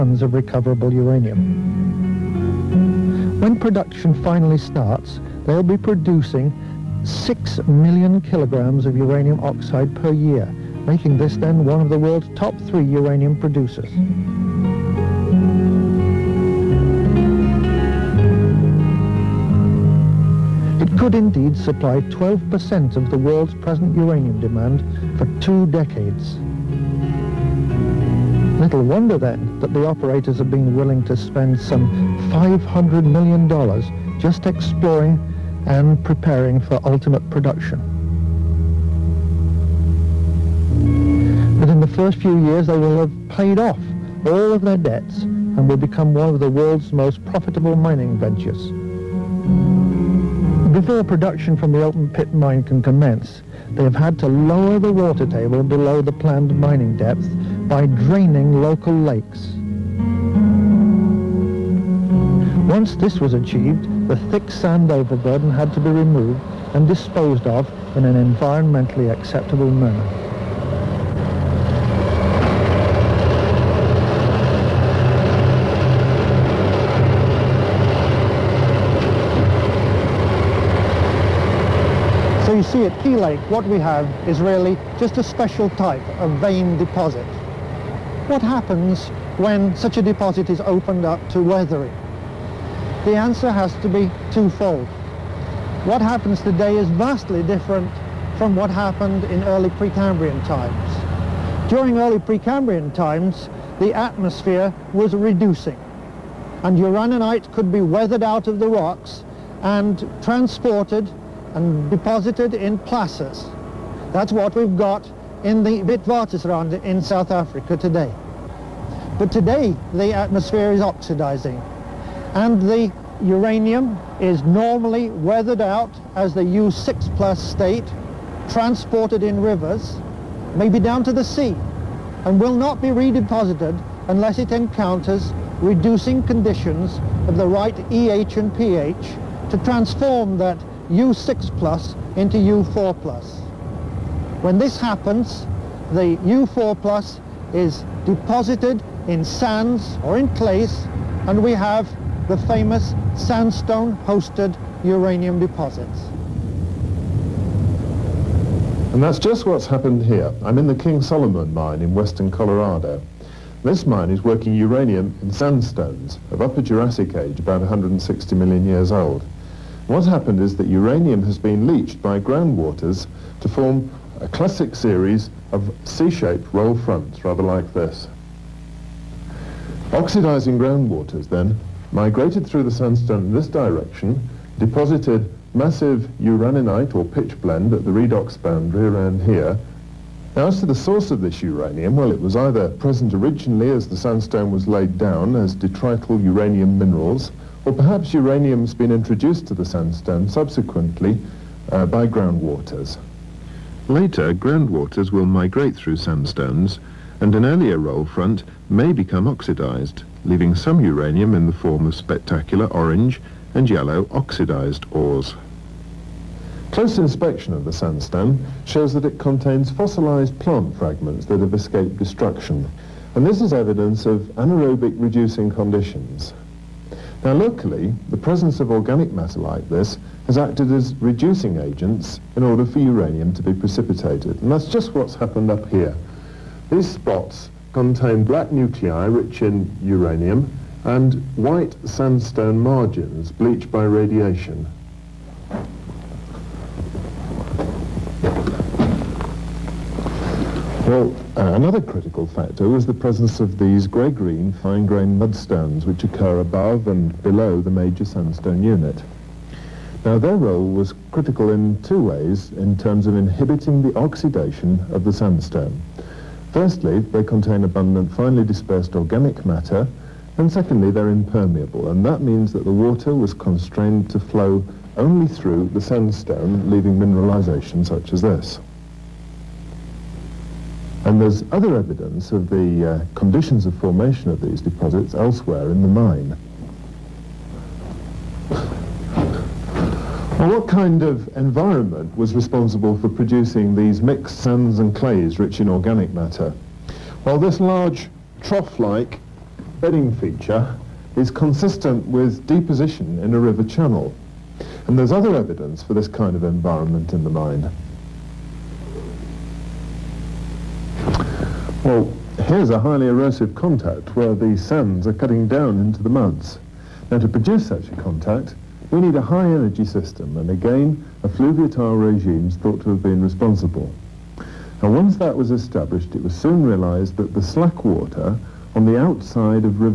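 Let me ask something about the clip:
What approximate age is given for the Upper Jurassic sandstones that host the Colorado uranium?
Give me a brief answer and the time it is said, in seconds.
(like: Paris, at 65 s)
160 million years, at 167 s.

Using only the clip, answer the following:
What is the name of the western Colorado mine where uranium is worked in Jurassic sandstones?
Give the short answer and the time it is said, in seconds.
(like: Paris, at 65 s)
King Solomon mine, at 160 s.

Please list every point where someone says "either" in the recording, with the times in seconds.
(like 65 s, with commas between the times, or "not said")
192 s.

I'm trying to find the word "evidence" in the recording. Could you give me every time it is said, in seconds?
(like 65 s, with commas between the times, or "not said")
223 s, 281 s, 305 s.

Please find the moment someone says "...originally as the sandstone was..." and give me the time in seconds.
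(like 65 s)
193 s.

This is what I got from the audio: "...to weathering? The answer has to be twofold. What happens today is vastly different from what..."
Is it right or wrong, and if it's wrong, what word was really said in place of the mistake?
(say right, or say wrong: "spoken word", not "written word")
right.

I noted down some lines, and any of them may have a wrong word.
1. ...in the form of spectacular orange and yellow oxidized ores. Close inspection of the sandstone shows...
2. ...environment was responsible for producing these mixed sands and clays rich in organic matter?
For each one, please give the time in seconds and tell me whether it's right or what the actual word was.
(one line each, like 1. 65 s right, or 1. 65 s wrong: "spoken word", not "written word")
1. 211 s right
2. 291 s right.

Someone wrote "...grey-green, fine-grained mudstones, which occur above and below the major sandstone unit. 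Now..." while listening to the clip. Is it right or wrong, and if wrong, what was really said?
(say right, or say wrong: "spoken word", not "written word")
right.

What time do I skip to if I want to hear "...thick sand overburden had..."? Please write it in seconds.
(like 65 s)
64 s.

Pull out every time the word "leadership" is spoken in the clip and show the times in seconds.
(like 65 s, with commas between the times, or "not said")
not said.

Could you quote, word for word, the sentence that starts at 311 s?
Well, here's a highly erosive contact where the sands are cutting down into the muds.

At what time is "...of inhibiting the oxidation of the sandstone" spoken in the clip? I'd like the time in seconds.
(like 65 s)
263 s.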